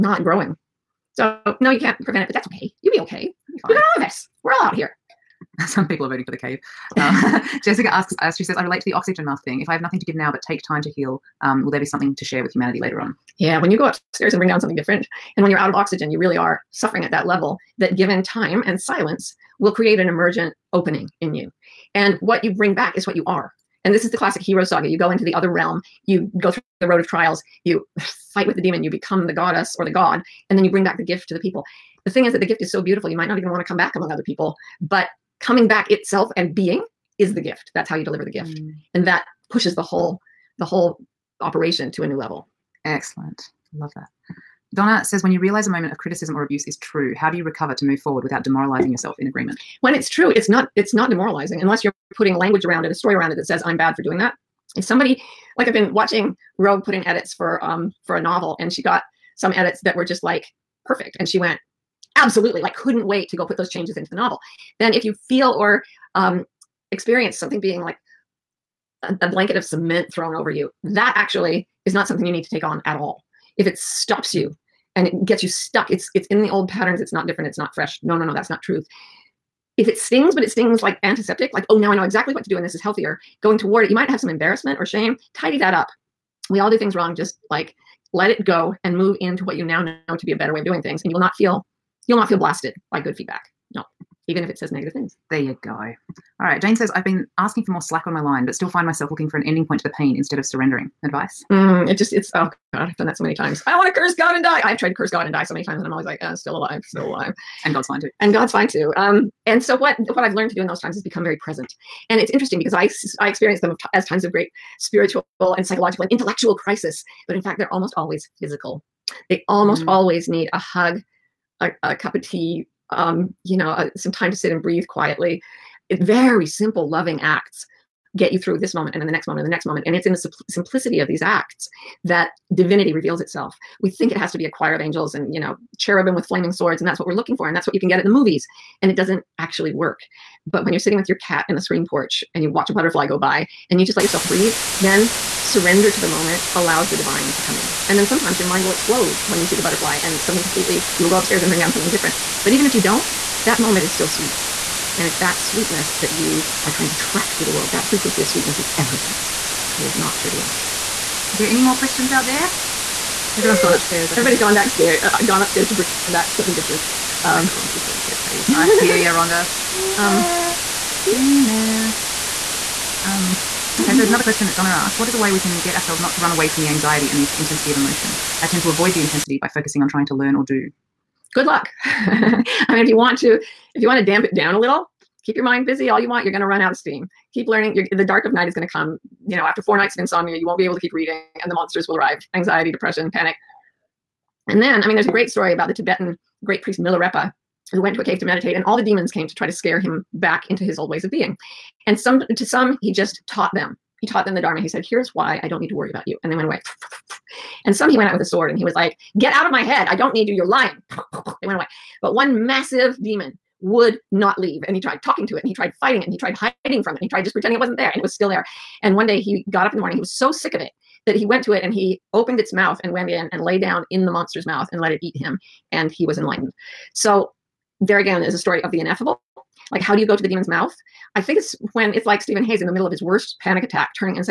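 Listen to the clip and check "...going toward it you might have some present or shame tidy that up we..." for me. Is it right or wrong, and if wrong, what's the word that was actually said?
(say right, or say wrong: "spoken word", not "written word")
wrong: "embarrassment", not "present".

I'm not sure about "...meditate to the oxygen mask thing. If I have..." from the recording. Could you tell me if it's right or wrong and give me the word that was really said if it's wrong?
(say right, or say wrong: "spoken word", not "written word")
wrong: "relate", not "meditate".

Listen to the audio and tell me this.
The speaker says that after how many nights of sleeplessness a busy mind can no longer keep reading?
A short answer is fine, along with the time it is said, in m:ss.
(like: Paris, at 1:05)
4, at 3:09.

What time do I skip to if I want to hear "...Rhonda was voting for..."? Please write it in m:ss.
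2:47.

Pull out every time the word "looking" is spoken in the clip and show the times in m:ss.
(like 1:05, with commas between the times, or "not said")
1:39, 2:17.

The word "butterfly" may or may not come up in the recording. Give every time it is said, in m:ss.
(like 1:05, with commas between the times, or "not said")
2:22, 2:29.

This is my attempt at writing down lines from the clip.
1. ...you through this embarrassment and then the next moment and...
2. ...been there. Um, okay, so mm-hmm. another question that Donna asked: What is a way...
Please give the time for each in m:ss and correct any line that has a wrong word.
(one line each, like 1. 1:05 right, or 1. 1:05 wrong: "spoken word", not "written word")
1. 2:08 wrong: "moment", not "embarrassment"
2. 2:51 right.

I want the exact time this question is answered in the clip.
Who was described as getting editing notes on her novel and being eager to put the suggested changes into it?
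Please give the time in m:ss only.
0:56.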